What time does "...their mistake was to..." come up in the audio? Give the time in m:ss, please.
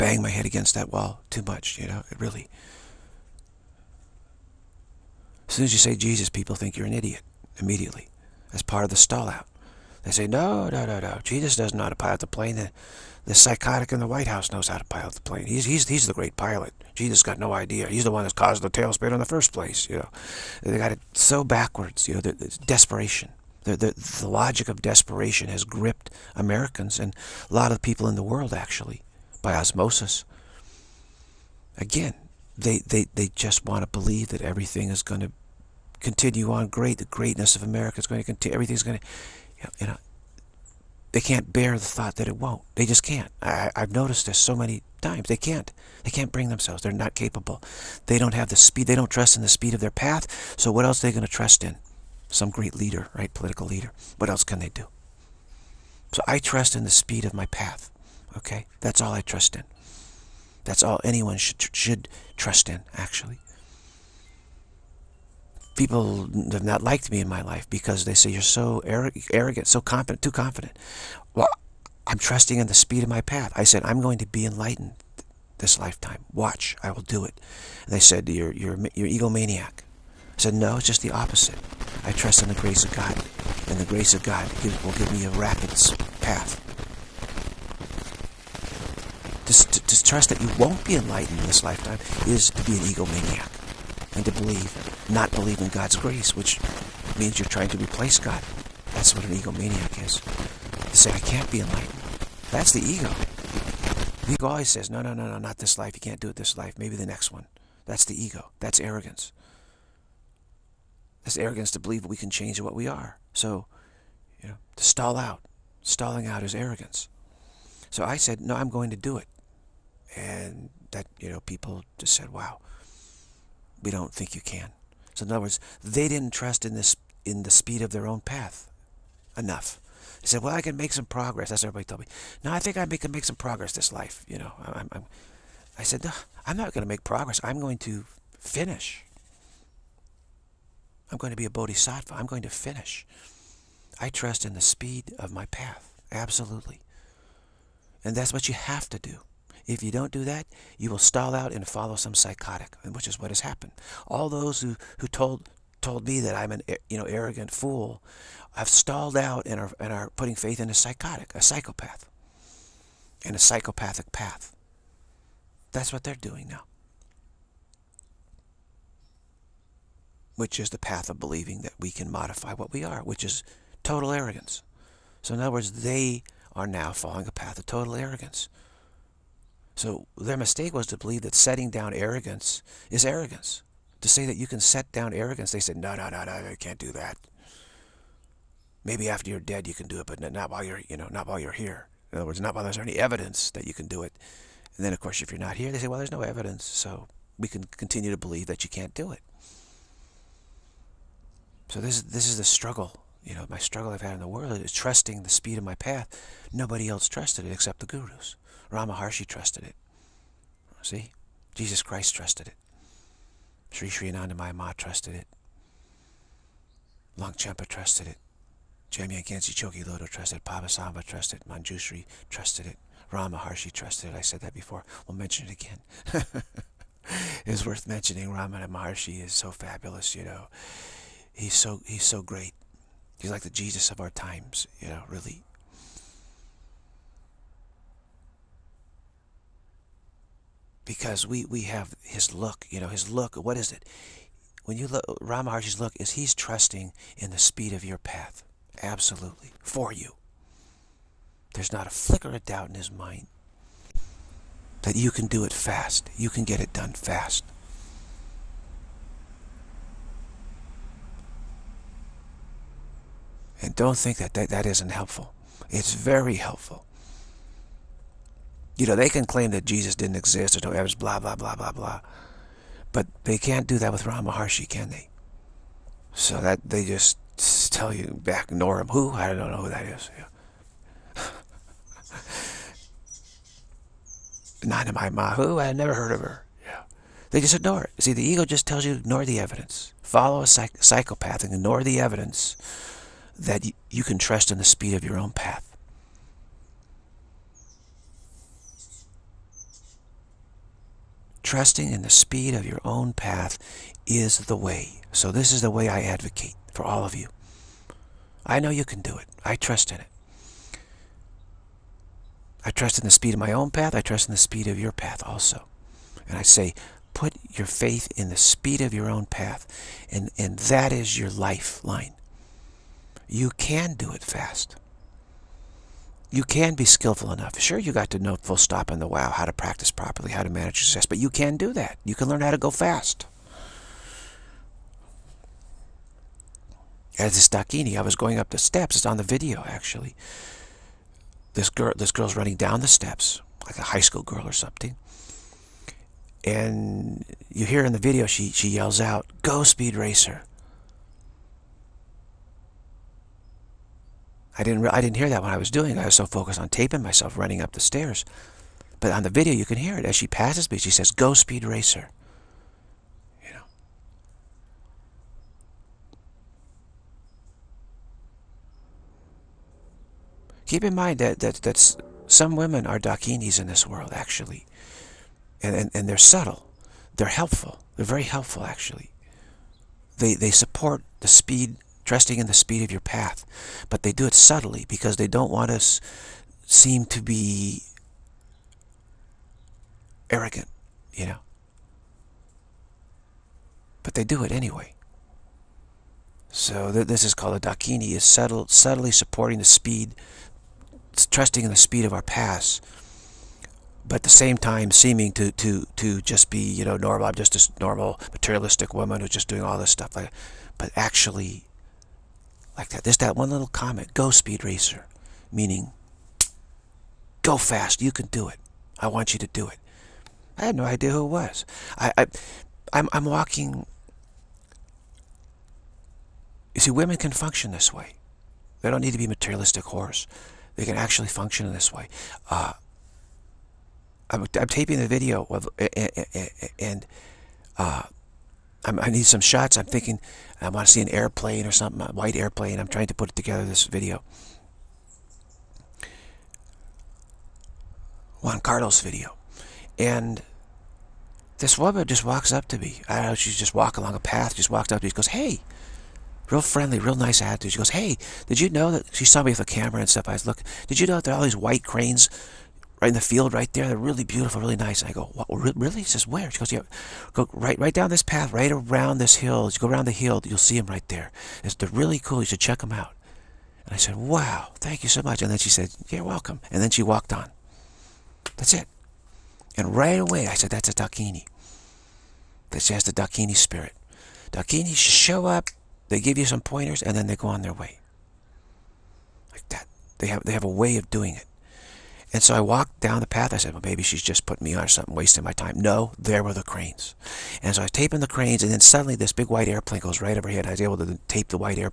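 3:00.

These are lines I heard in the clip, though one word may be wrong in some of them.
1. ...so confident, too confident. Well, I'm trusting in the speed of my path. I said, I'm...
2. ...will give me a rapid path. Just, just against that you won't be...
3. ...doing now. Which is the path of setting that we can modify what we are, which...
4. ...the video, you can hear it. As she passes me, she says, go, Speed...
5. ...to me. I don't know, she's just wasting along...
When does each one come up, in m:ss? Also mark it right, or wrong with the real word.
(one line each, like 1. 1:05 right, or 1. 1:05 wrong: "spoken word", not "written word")
1. 1:09 right
2. 1:24 wrong: "trust", not "against"
3. 2:46 wrong: "believing", not "setting"
4. 5:59 right
5. 7:32 wrong: "walking", not "wasting".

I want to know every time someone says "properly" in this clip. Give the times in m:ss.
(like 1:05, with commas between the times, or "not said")
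5:29.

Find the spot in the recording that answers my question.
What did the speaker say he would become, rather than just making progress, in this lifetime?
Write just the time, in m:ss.
2:21.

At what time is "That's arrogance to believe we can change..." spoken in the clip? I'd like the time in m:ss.
1:51.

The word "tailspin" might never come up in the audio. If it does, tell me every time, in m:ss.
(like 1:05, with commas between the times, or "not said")
0:18.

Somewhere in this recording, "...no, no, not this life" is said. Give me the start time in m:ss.
1:45.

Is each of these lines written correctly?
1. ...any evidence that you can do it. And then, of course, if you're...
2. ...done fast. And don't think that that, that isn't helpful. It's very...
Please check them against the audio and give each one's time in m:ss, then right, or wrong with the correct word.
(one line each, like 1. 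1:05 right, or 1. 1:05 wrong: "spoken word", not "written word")
1. 3:12 right
2. 4:16 right.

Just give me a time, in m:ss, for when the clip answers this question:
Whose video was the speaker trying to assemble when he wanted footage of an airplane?
7:28.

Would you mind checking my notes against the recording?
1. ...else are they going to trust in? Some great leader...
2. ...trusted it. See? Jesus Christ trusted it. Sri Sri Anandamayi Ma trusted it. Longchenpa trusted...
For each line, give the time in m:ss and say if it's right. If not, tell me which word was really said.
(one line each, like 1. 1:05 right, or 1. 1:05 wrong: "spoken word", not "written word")
1. 0:50 right
2. 3:29 right.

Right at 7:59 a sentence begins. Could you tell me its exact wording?
And right away, I said, that's a Dakini.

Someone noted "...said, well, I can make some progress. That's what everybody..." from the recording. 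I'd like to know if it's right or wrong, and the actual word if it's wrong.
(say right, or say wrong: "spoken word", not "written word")
right.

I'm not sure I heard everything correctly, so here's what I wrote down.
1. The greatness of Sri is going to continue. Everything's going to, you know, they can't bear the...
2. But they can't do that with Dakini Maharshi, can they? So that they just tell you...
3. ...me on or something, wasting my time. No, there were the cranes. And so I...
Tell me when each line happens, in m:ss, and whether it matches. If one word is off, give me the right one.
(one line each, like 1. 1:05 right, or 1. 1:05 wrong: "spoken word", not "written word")
1. 0:36 wrong: "America", not "Sri"
2. 4:32 wrong: "Ramana", not "Dakini"
3. 8:14 right.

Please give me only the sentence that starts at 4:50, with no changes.
Follow a psych psychopath and ignore the evidence that you can trust in the speed of your own path.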